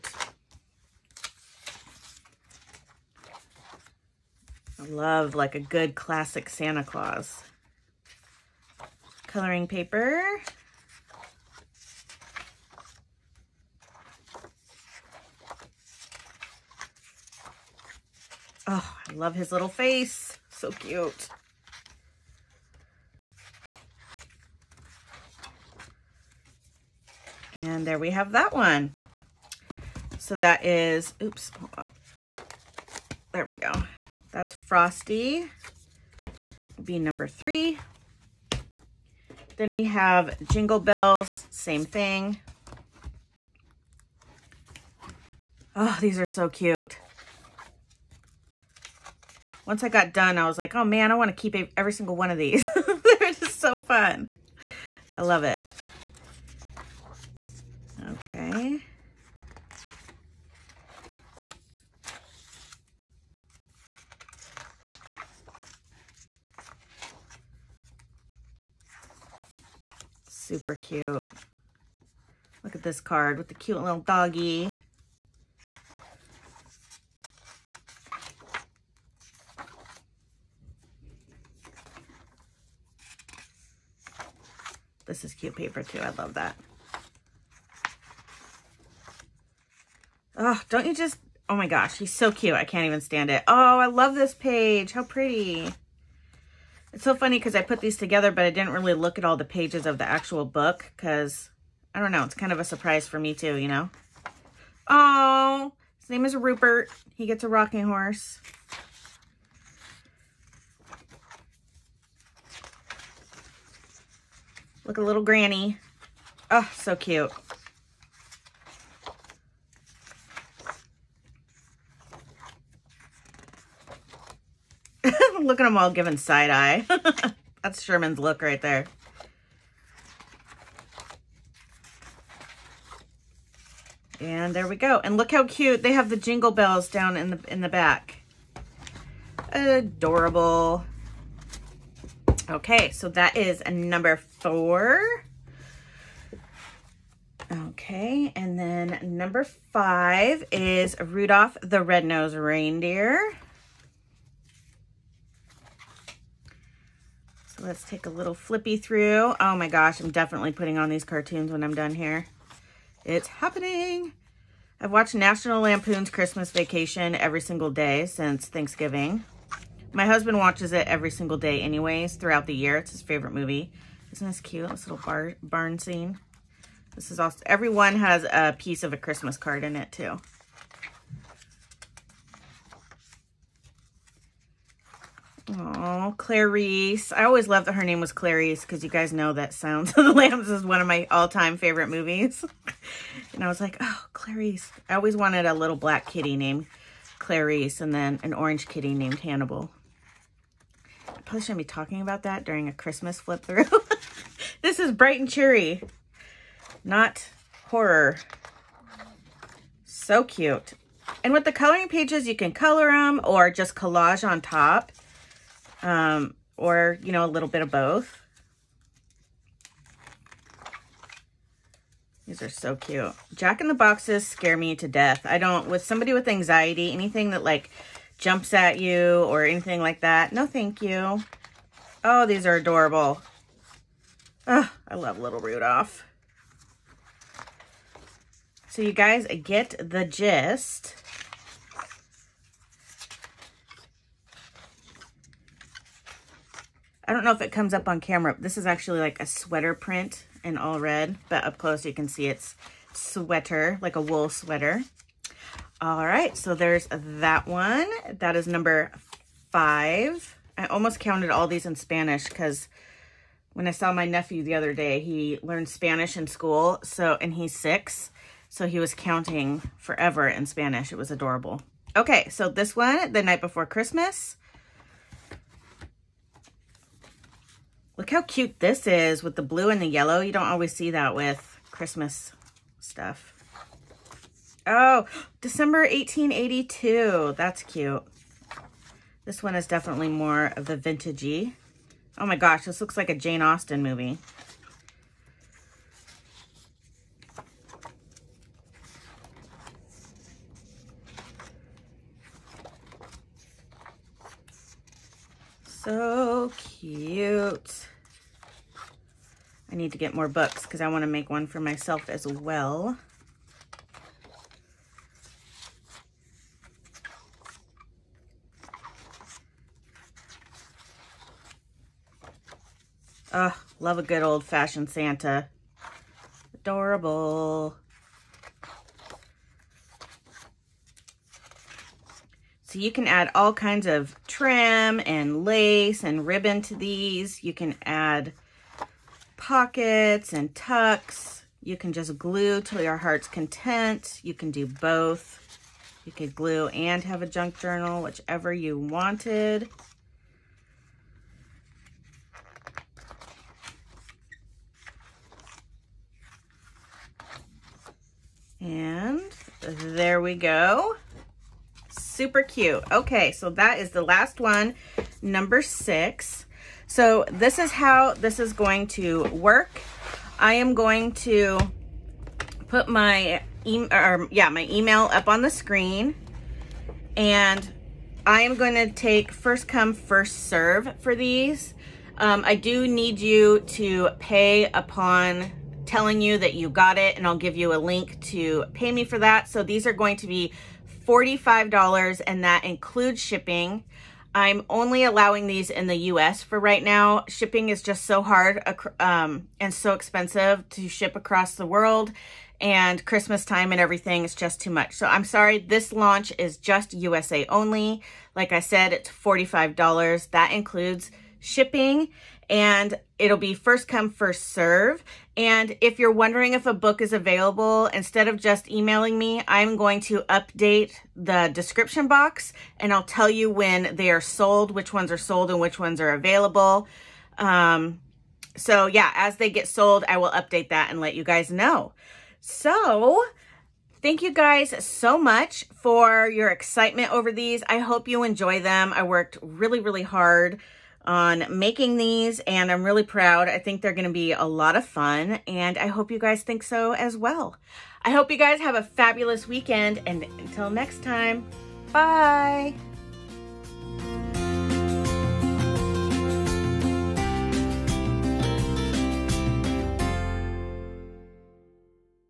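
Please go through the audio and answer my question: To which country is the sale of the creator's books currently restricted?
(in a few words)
USA.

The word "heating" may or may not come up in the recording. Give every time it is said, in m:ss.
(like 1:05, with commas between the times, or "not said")
not said.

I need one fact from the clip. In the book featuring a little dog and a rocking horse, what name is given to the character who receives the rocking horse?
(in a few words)
Rupert.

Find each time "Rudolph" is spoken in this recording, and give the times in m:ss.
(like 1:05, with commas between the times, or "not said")
2:31, 3:55.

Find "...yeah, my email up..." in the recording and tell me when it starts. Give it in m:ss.
6:14.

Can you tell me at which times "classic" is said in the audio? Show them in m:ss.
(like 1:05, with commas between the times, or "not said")
0:05.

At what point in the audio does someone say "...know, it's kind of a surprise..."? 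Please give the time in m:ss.
1:42.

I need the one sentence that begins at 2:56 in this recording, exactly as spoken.
This is also, everyone has a piece of a Christmas card in it too.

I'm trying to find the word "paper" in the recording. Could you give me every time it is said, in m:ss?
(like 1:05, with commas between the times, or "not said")
0:09, 1:25.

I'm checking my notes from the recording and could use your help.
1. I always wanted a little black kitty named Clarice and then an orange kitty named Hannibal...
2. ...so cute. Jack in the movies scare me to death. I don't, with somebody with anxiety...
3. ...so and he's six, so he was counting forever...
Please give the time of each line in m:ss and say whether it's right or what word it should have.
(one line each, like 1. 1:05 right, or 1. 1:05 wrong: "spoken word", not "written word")
1. 3:14 right
2. 3:42 wrong: "boxes", not "movies"
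3. 4:26 right.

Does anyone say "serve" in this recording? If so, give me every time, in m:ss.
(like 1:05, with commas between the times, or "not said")
6:20, 6:54.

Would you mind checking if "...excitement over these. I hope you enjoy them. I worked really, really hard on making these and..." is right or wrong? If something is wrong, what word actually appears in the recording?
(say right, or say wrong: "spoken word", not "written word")
right.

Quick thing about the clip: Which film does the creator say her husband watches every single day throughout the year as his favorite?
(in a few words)
National Lampoon's Christmas Vacation.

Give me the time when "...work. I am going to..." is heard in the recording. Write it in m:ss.
6:09.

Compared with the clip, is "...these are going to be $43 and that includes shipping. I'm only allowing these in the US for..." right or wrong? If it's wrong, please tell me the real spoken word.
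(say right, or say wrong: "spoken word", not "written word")
wrong: "45", not "43".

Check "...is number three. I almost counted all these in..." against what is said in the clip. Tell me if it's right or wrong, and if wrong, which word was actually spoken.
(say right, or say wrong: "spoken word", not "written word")
wrong: "five", not "three".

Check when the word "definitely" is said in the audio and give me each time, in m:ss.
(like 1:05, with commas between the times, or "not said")
2:40, 4:49.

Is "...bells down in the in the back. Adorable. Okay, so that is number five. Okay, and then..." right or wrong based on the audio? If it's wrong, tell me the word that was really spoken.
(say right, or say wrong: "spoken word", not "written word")
wrong: "four", not "five".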